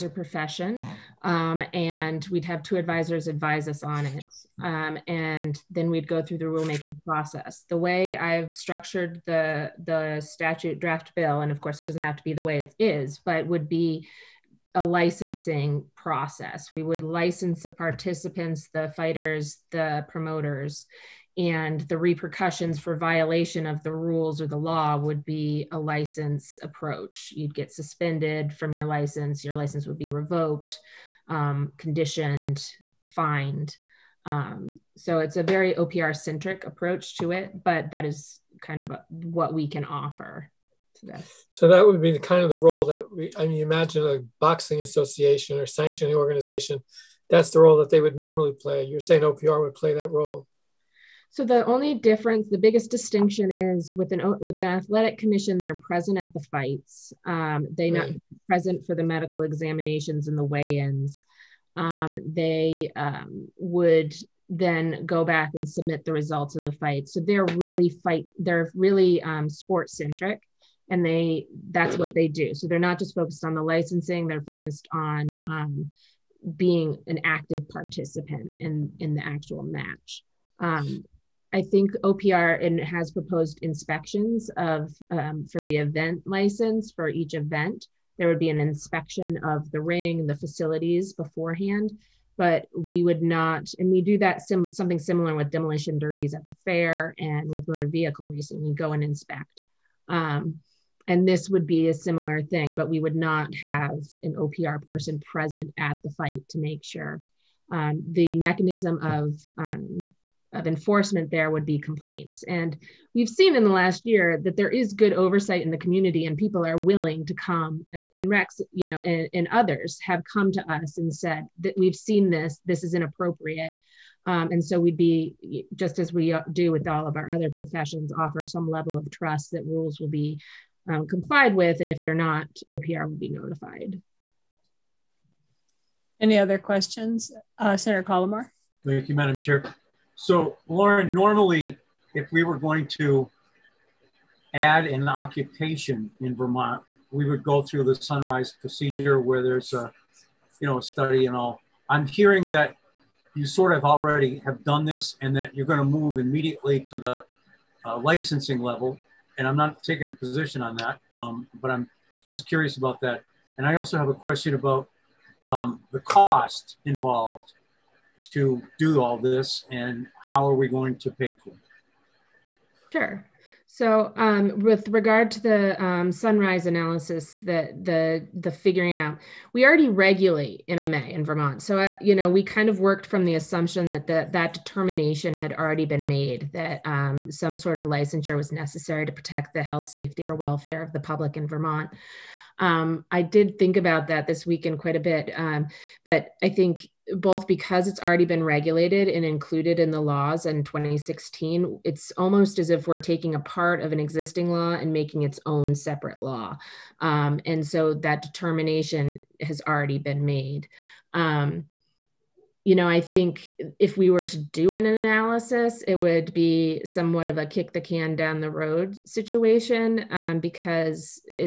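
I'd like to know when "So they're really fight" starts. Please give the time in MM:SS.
01:07.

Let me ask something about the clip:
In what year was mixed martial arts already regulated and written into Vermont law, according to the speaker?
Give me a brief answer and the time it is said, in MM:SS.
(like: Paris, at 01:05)
2016, at 03:20.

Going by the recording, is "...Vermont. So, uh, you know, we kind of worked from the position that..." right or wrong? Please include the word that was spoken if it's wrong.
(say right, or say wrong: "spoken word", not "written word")
wrong: "assumption", not "position".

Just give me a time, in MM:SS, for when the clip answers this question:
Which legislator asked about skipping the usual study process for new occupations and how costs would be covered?
02:17.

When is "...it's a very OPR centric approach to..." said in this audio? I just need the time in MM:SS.
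00:35.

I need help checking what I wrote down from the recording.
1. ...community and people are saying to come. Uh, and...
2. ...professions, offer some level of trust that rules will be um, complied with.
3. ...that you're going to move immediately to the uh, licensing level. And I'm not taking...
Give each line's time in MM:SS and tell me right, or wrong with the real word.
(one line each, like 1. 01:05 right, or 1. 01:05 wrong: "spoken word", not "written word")
1. 01:55 wrong: "willing", not "saying"
2. 02:07 right
3. 02:35 right.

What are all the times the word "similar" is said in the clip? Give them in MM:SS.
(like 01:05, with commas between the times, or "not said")
01:34, 01:41.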